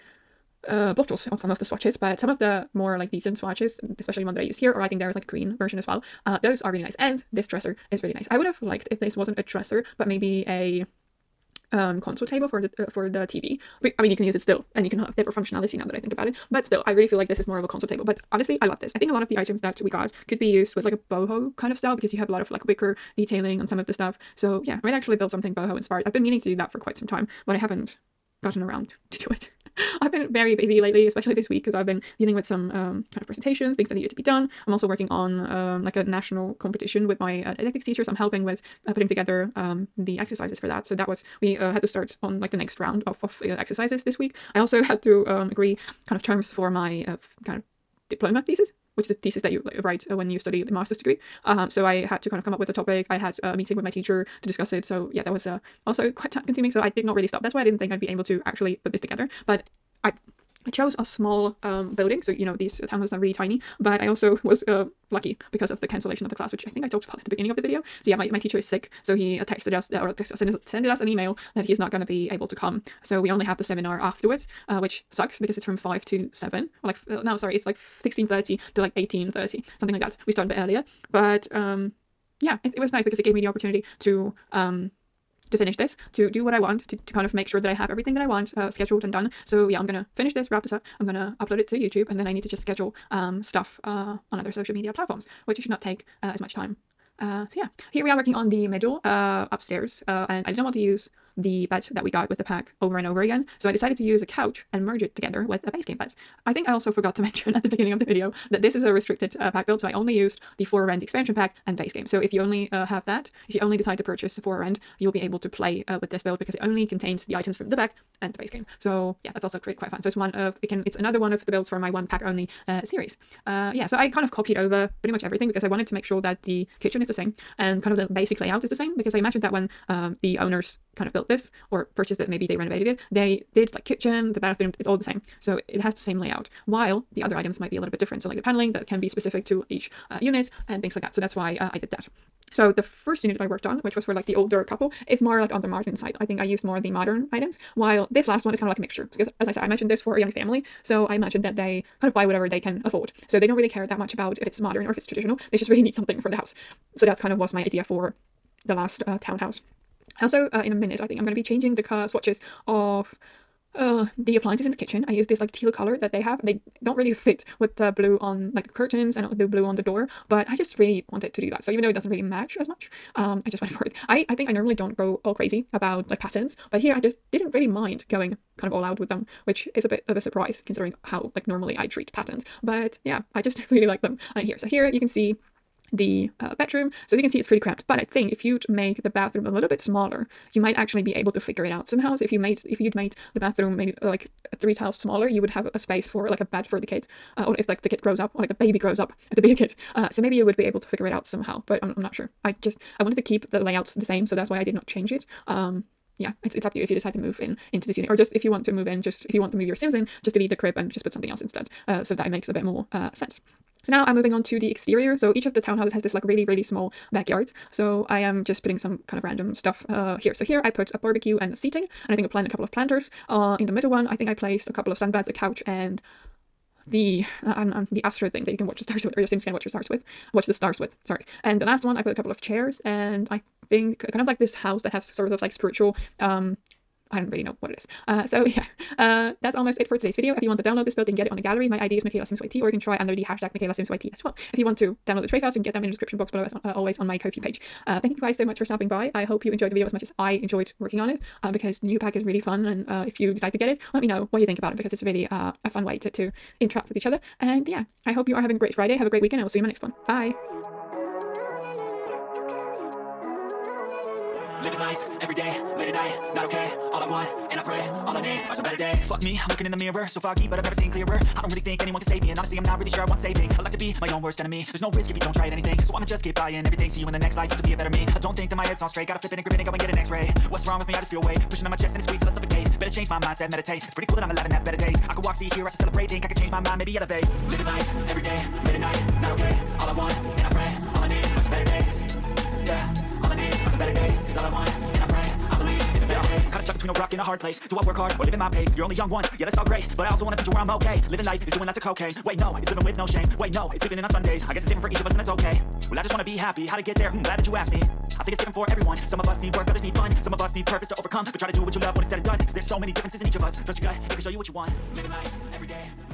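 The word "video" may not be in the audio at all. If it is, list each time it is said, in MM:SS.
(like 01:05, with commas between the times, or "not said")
01:07, 01:48, 04:00, 04:09.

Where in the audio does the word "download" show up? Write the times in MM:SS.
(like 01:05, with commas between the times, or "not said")
04:00, 04:05.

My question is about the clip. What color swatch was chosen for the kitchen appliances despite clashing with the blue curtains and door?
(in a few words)
teal.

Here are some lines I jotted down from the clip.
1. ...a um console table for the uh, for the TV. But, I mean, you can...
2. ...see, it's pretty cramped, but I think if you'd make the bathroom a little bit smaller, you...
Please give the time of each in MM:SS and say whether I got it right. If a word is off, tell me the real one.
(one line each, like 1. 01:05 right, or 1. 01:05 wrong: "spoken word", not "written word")
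1. 00:10 right
2. 03:07 right.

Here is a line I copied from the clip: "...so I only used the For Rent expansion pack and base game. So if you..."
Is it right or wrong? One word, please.
right.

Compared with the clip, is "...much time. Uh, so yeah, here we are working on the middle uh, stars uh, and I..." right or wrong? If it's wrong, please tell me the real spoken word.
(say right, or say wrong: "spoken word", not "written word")
wrong: "upstairs", not "stars".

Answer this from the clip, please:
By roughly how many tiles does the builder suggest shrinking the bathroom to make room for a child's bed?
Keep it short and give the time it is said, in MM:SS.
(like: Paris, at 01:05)
3, at 03:14.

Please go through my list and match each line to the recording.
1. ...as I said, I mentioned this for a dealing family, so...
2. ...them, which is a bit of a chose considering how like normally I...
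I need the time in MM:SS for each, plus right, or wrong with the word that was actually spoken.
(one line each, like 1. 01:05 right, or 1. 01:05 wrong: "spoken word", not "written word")
1. 02:29 wrong: "young", not "dealing"
2. 02:59 wrong: "surprise", not "chose".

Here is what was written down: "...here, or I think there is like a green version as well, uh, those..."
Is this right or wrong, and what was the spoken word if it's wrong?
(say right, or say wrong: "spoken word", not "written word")
right.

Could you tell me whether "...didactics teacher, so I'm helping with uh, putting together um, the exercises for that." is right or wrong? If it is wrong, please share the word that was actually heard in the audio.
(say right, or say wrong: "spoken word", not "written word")
right.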